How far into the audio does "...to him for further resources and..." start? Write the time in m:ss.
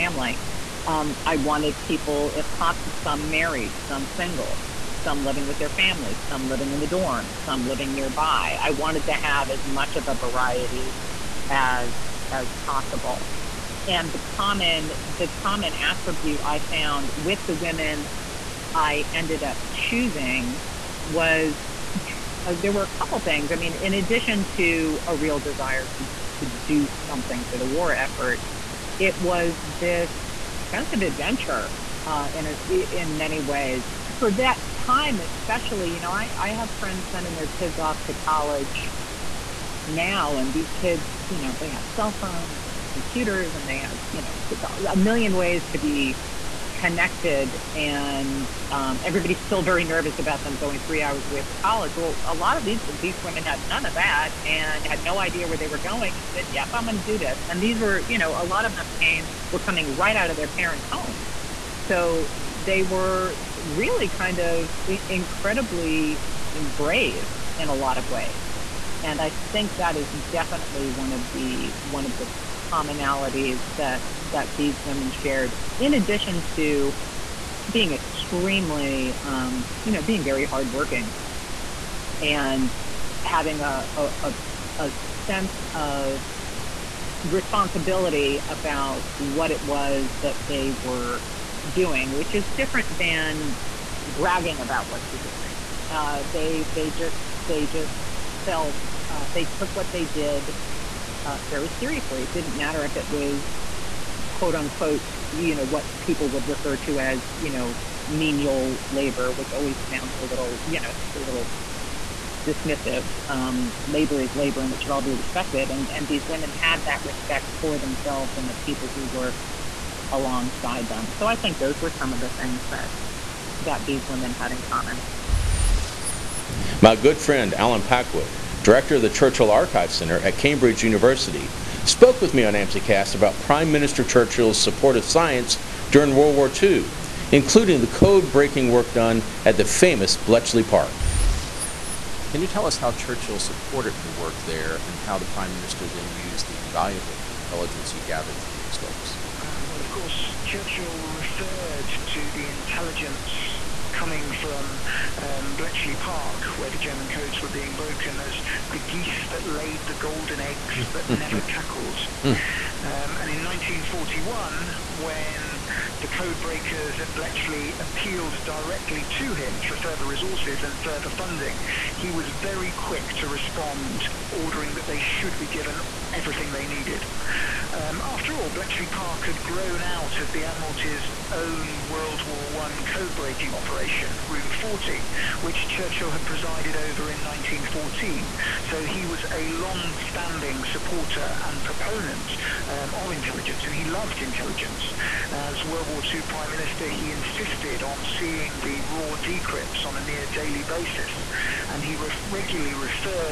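2:49.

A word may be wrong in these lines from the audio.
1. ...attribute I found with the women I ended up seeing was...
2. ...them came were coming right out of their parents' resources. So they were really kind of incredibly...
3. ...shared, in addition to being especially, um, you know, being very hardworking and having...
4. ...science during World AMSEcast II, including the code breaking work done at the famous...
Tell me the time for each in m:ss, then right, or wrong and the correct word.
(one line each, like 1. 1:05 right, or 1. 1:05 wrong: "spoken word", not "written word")
1. 0:15 wrong: "choosing", not "seeing"
2. 0:58 wrong: "homes", not "resources"
3. 1:15 wrong: "extremely", not "especially"
4. 2:15 wrong: "War", not "AMSEcast".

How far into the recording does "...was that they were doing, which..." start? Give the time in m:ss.
1:29.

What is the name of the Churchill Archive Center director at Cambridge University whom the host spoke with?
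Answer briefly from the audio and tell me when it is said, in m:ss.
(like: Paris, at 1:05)
Alan Packwood, at 2:07.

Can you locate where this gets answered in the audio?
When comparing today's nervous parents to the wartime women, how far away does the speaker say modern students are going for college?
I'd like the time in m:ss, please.
0:50.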